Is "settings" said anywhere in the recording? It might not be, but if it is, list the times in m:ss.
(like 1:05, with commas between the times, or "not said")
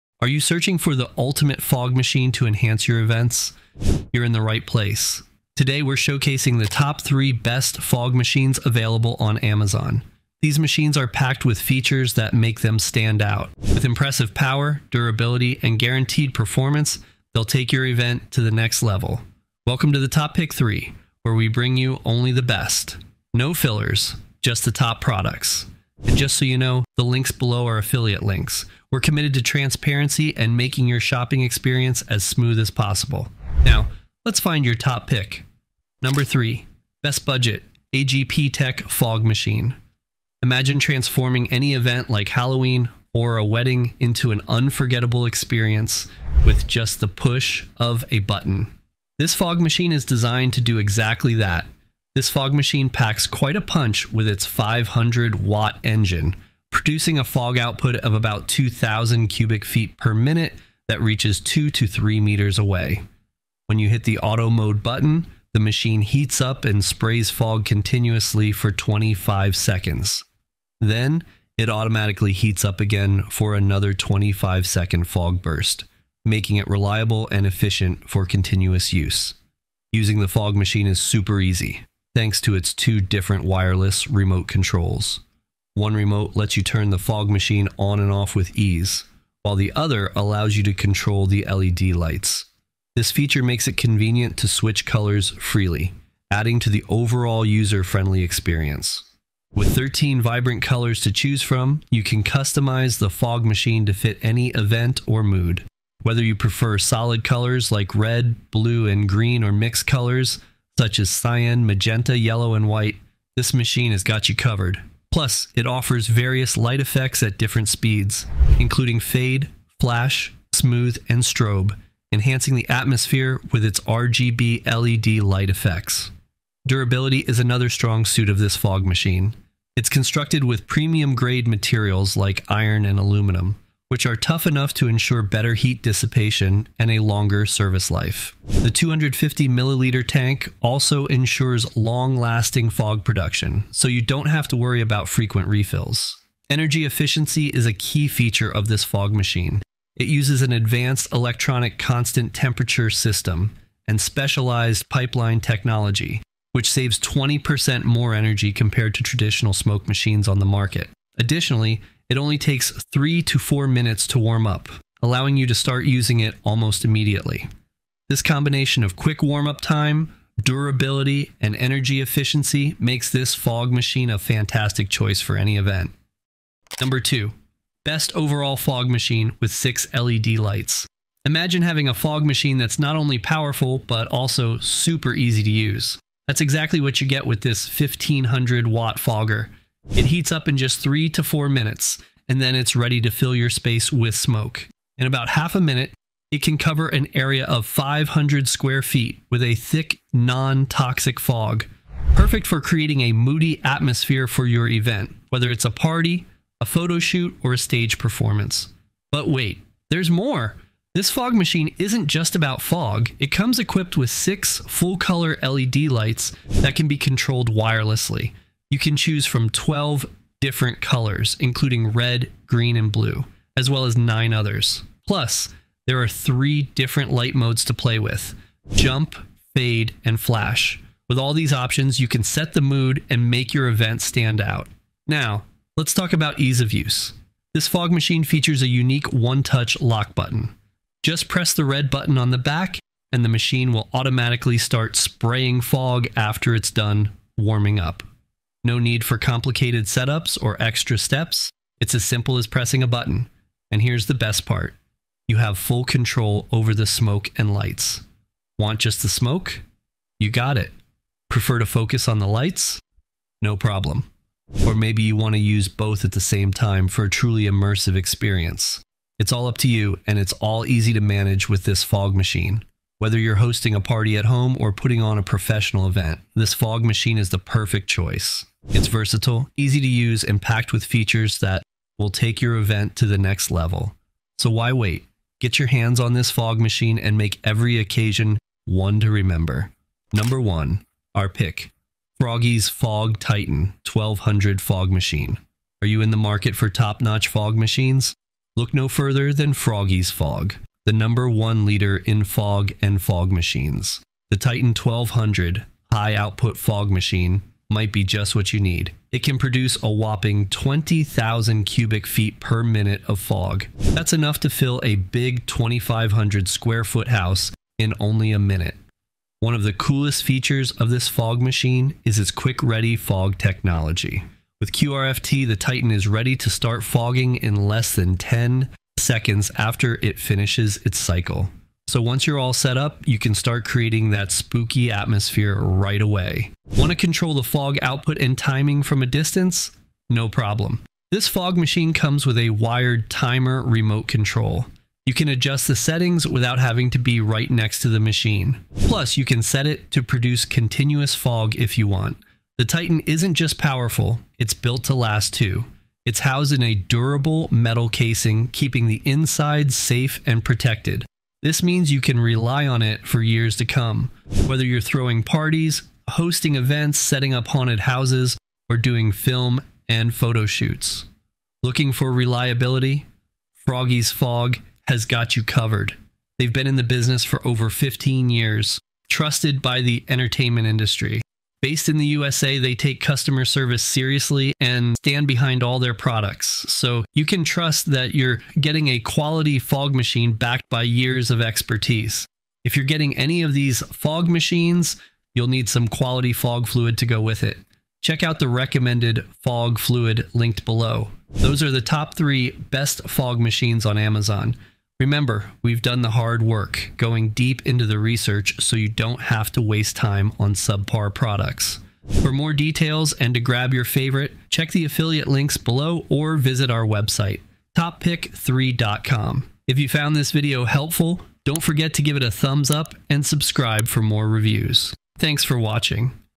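5:45, 6:06.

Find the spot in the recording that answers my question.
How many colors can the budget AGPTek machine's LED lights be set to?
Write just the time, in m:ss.
1:39.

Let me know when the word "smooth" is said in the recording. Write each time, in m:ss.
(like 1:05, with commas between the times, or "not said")
0:32, 2:00.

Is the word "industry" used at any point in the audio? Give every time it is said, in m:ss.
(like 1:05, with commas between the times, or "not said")
6:20.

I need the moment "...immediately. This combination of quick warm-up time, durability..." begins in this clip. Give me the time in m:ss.
2:46.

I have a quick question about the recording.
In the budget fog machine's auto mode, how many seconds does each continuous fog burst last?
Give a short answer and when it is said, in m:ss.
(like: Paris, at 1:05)
25 seconds, at 1:08.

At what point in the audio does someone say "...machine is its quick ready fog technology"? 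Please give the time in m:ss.
5:21.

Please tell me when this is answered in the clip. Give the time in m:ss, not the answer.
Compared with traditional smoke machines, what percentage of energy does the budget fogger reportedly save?
2:36.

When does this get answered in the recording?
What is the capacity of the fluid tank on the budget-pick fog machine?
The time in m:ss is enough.
2:18.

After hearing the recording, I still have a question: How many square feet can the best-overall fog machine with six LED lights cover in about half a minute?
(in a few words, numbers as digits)
500 square feet.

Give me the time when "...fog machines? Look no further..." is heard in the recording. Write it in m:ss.
4:57.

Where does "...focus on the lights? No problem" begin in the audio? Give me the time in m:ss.
4:21.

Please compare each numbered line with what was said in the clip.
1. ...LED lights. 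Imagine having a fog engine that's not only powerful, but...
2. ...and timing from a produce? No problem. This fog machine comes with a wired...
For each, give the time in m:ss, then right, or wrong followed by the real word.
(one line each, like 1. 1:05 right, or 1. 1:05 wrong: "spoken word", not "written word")
1. 2:59 wrong: "machine", not "engine"
2. 5:38 wrong: "distance", not "produce".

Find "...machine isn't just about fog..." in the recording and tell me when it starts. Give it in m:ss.
3:31.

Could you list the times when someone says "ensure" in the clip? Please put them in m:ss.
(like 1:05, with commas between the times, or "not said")
2:14, 2:21.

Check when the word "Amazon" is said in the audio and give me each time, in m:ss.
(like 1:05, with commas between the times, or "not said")
0:09, 6:43.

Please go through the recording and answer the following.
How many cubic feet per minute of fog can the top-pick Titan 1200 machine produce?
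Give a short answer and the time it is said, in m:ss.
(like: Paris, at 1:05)
20,000, at 5:10.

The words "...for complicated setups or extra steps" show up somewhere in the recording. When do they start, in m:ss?
4:09.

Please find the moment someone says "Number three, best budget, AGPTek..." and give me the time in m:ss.
0:36.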